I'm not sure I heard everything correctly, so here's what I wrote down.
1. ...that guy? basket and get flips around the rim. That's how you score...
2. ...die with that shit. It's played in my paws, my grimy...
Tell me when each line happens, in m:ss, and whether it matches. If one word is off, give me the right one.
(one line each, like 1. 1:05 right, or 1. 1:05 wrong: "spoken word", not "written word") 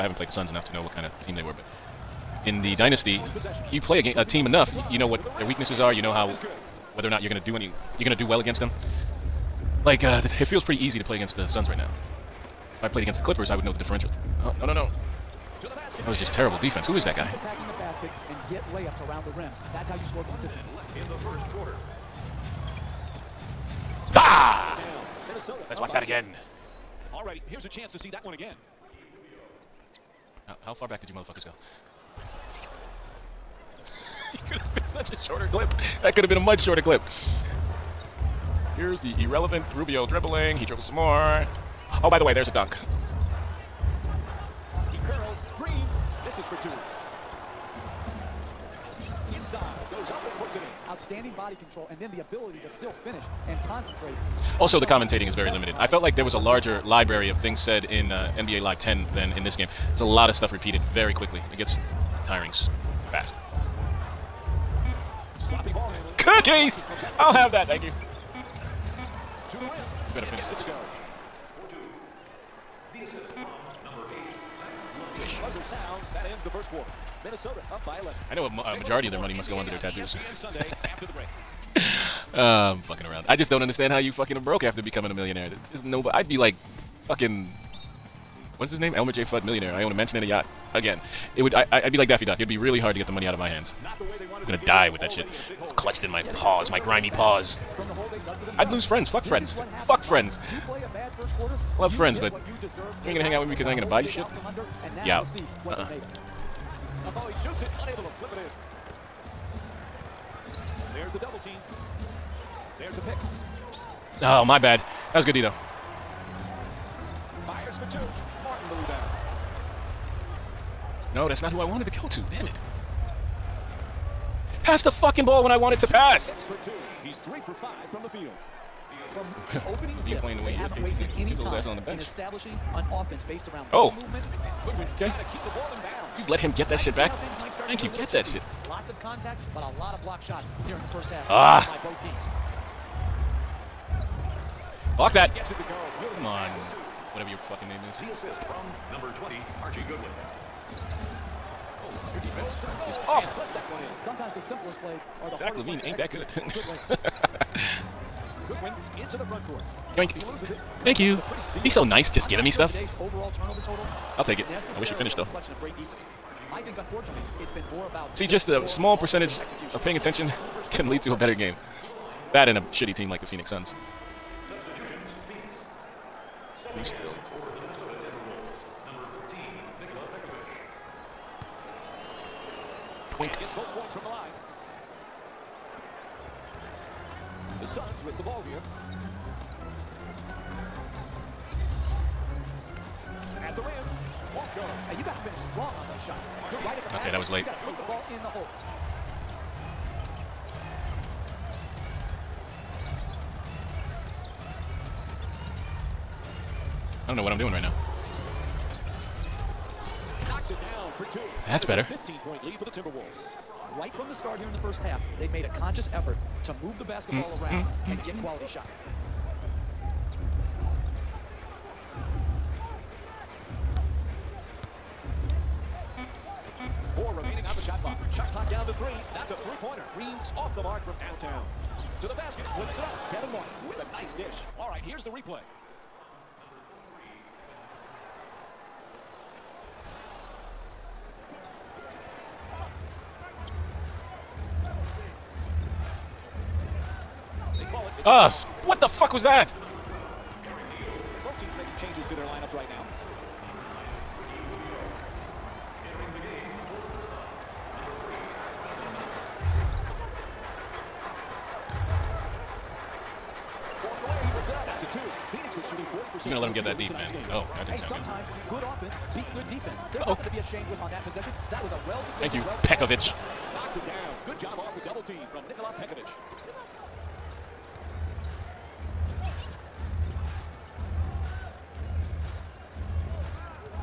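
1. 0:17 wrong: "layups", not "flips"
2. 1:34 wrong: "clutched", not "played".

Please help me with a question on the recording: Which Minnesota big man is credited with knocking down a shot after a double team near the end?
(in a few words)
Nikola Pekovic.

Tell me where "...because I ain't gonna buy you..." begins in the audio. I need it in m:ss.
1:43.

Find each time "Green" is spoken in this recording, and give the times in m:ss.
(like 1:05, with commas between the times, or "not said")
0:45, 3:49.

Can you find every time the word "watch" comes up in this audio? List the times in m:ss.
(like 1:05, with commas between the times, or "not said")
0:25.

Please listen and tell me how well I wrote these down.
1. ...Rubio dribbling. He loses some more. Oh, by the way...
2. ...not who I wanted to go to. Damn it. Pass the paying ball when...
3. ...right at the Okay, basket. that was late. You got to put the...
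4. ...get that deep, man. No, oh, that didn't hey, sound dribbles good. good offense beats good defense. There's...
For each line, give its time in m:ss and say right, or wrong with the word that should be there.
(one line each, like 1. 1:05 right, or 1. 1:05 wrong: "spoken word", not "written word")
1. 0:39 wrong: "dribbles", not "loses"
2. 2:01 wrong: "fucking", not "paying"
3. 3:16 right
4. 4:26 wrong: "sometimes", not "dribbles".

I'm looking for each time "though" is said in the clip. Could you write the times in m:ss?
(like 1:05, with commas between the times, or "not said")
1:55, 2:45.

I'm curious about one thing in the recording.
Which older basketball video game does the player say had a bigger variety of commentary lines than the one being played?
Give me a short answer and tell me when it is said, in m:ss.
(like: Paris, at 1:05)
NBA Live 10, at 0:58.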